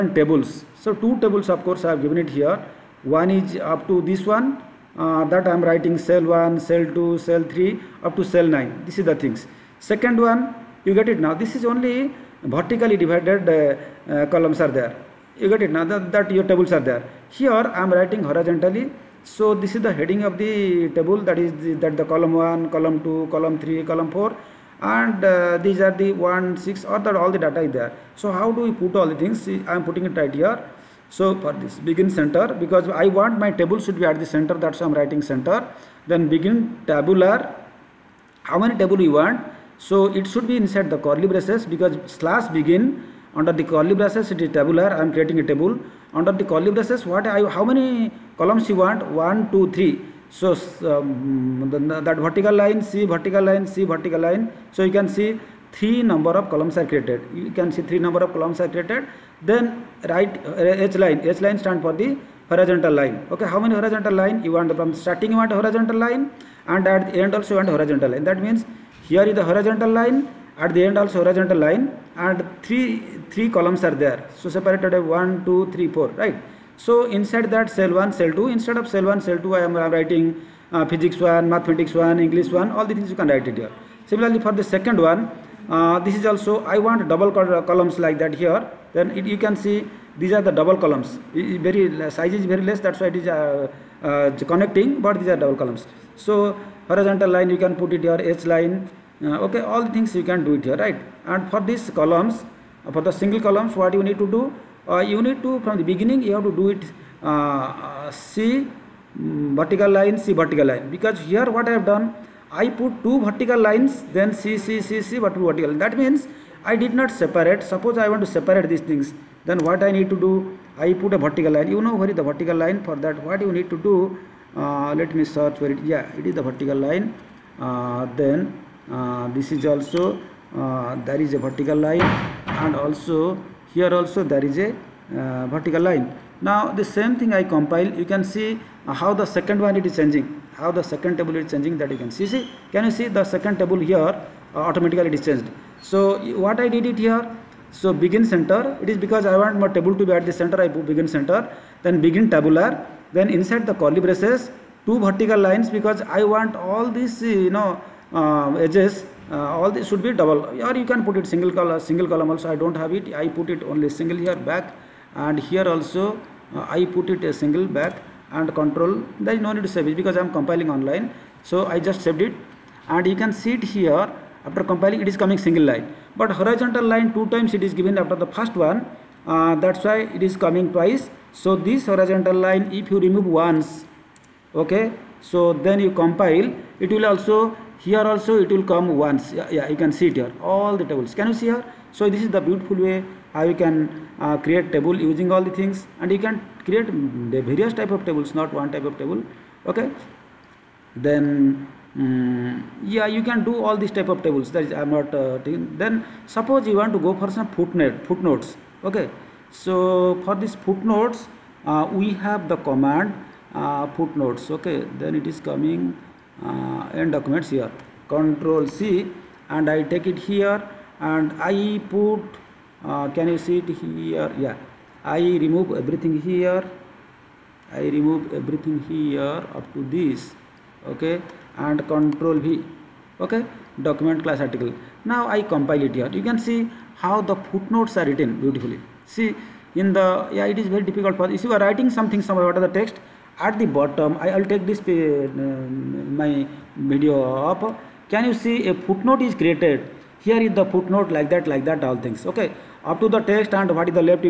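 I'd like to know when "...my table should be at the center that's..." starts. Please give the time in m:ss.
0:33.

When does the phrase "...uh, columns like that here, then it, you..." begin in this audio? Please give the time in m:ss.
1:27.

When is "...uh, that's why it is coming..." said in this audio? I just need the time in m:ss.
2:59.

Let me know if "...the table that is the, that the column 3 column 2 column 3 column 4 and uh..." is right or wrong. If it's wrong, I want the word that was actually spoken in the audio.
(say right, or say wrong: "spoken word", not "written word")
wrong: "1", not "3".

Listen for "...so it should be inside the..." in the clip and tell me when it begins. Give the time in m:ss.
0:39.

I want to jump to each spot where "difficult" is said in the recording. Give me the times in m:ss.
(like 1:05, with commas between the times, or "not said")
4:00.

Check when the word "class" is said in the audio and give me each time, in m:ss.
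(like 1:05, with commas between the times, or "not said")
3:54.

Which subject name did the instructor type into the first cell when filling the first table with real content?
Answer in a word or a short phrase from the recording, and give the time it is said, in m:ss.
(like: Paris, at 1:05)
Physics 1, at 1:20.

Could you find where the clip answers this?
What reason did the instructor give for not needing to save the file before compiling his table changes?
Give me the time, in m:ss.
2:50.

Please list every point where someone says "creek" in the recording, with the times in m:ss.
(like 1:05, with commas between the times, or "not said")
not said.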